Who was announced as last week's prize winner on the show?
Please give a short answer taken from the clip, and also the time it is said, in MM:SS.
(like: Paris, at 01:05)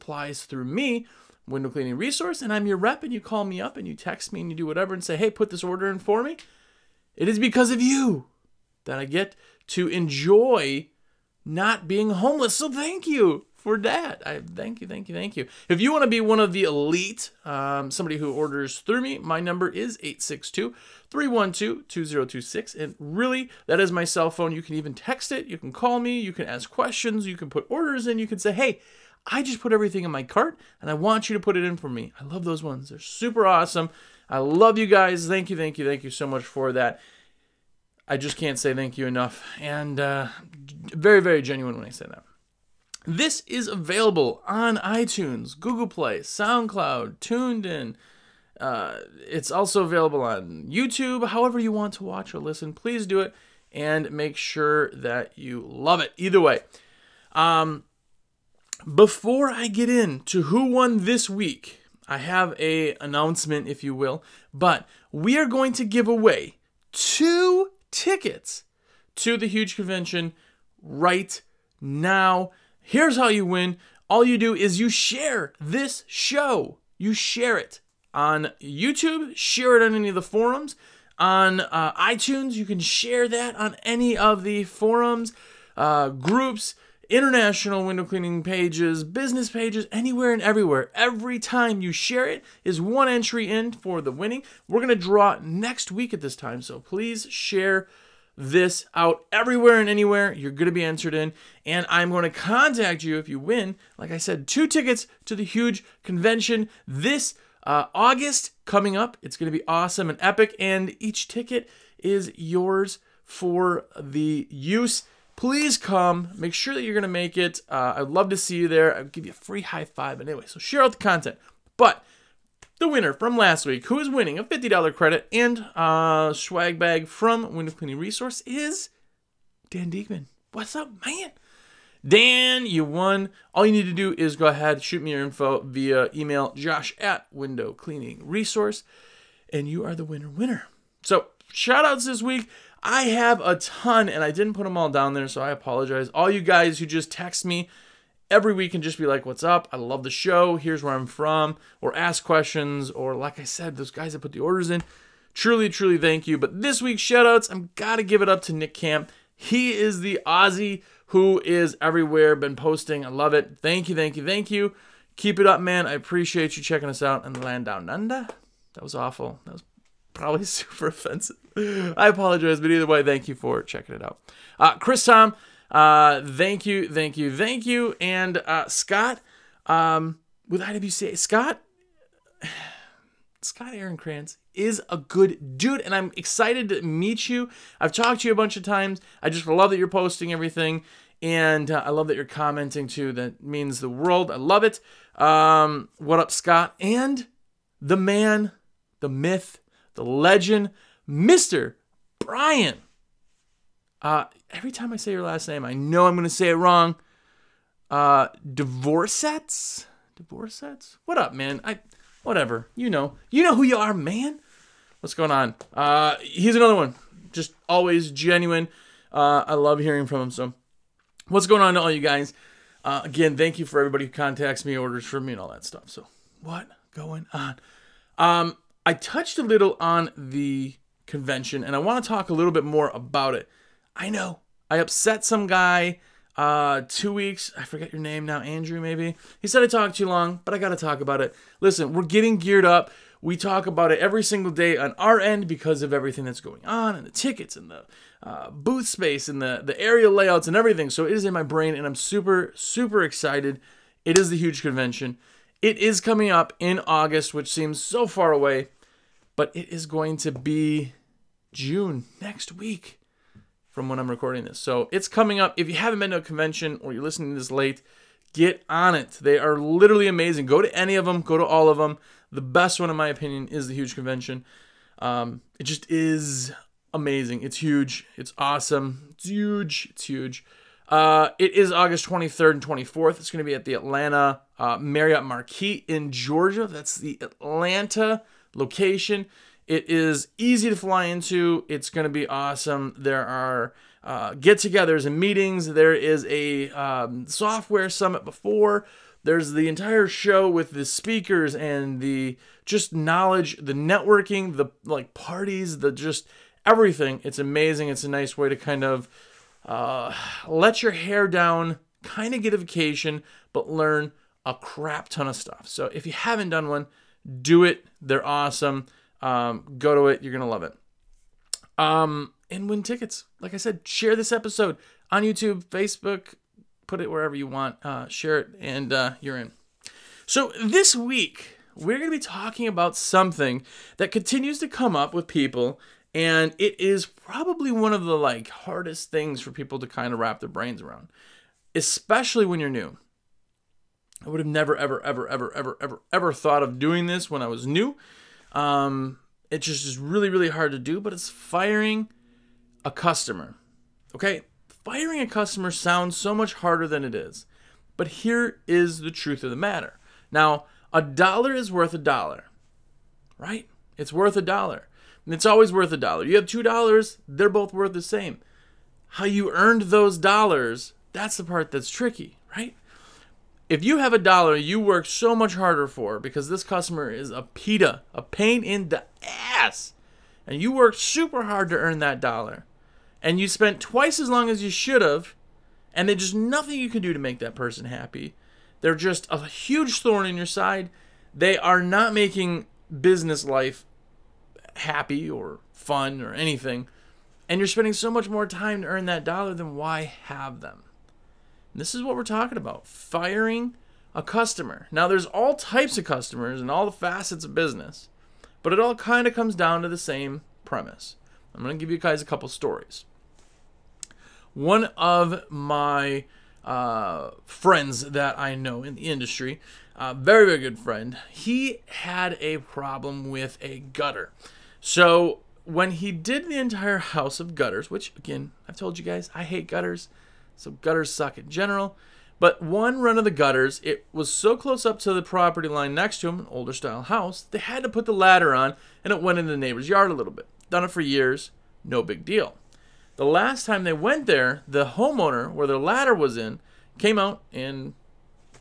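Dan Diegman, at 02:09.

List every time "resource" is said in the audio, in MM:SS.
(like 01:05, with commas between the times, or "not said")
00:01, 02:07, 02:18.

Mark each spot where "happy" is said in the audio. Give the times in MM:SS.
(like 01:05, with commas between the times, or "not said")
06:27, 06:34.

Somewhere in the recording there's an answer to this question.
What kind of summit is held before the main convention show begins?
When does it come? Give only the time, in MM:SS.
04:57.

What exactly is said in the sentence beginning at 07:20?
Done it for years, no big deal.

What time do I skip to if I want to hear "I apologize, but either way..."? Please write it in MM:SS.
02:51.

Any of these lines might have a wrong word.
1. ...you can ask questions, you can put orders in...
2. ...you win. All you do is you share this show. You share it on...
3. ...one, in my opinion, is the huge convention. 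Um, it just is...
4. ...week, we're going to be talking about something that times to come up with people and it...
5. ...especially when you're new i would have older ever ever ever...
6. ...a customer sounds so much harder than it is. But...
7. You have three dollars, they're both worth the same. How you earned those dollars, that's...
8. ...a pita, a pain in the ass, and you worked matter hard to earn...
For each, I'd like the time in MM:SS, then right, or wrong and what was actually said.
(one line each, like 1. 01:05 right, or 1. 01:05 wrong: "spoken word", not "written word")
1. 00:26 right
2. 01:13 right
3. 04:32 right
4. 05:30 wrong: "continues", not "times"
5. 05:41 wrong: "never", not "older"
6. 05:55 right
7. 06:06 wrong: "two", not "three"
8. 06:17 wrong: "super", not "matter".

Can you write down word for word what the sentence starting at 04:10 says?
So it is in my brain, and I'm super, super excited.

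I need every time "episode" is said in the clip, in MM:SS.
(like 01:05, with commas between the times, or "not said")
05:24.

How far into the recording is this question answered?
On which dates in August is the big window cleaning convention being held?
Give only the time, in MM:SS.
04:41.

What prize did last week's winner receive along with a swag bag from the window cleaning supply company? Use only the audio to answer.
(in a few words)
$50 credit.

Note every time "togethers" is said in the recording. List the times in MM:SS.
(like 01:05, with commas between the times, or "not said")
04:54.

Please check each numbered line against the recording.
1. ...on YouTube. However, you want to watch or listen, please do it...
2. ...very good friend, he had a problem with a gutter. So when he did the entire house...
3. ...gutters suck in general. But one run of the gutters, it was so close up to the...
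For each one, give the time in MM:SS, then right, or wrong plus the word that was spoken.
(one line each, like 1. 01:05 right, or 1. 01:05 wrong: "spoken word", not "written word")
1. 00:50 right
2. 07:00 right
3. 07:10 right.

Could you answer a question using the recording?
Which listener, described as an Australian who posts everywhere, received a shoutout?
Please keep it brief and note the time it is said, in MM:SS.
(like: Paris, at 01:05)
Nick Camp, at 02:38.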